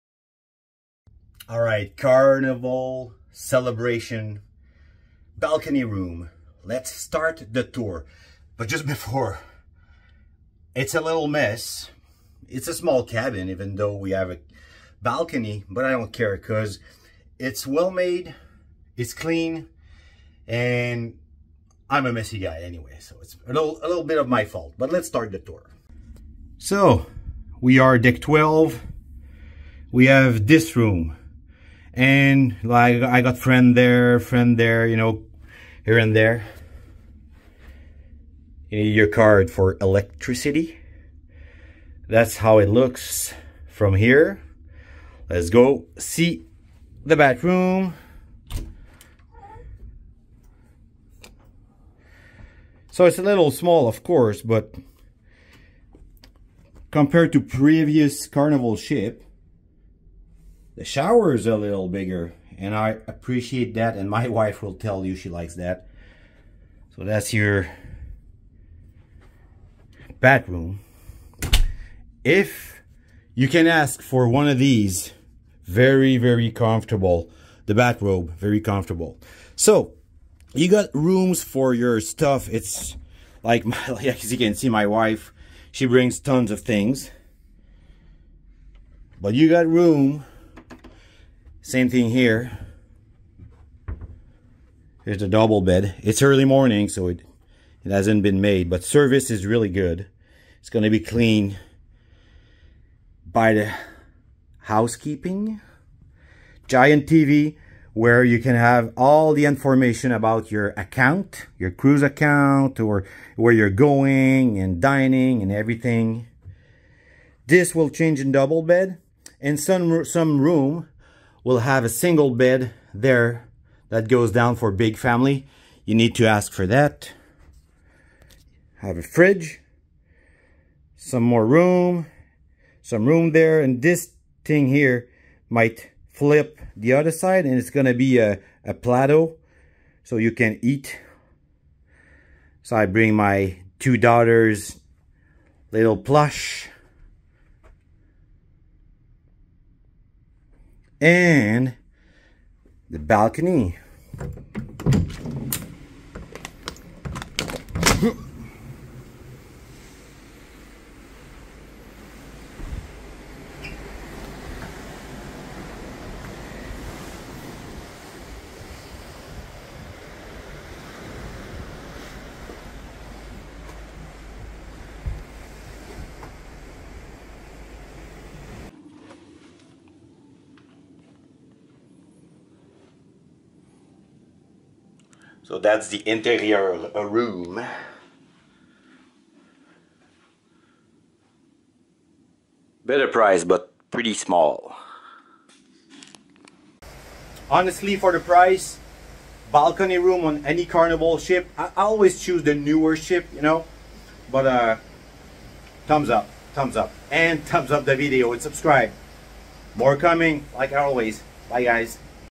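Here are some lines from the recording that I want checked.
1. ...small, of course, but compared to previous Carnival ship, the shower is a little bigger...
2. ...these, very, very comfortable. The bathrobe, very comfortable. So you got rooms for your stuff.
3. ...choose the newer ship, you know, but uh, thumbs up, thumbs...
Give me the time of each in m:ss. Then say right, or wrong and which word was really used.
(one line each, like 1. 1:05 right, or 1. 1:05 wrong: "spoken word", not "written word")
1. 0:53 right
2. 1:14 right
3. 3:22 right.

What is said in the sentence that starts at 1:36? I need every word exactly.
It's early morning, so it, it hasn't been made, but service is really good.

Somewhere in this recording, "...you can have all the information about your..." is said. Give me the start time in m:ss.
1:48.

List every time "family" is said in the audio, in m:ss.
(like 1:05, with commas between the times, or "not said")
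2:04.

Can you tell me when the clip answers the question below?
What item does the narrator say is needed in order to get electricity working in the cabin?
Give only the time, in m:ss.
0:38.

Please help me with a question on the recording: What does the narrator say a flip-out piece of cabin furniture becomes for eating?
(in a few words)
A plateau.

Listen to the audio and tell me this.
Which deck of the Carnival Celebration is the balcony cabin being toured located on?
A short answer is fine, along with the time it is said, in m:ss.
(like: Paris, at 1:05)
12, at 0:27.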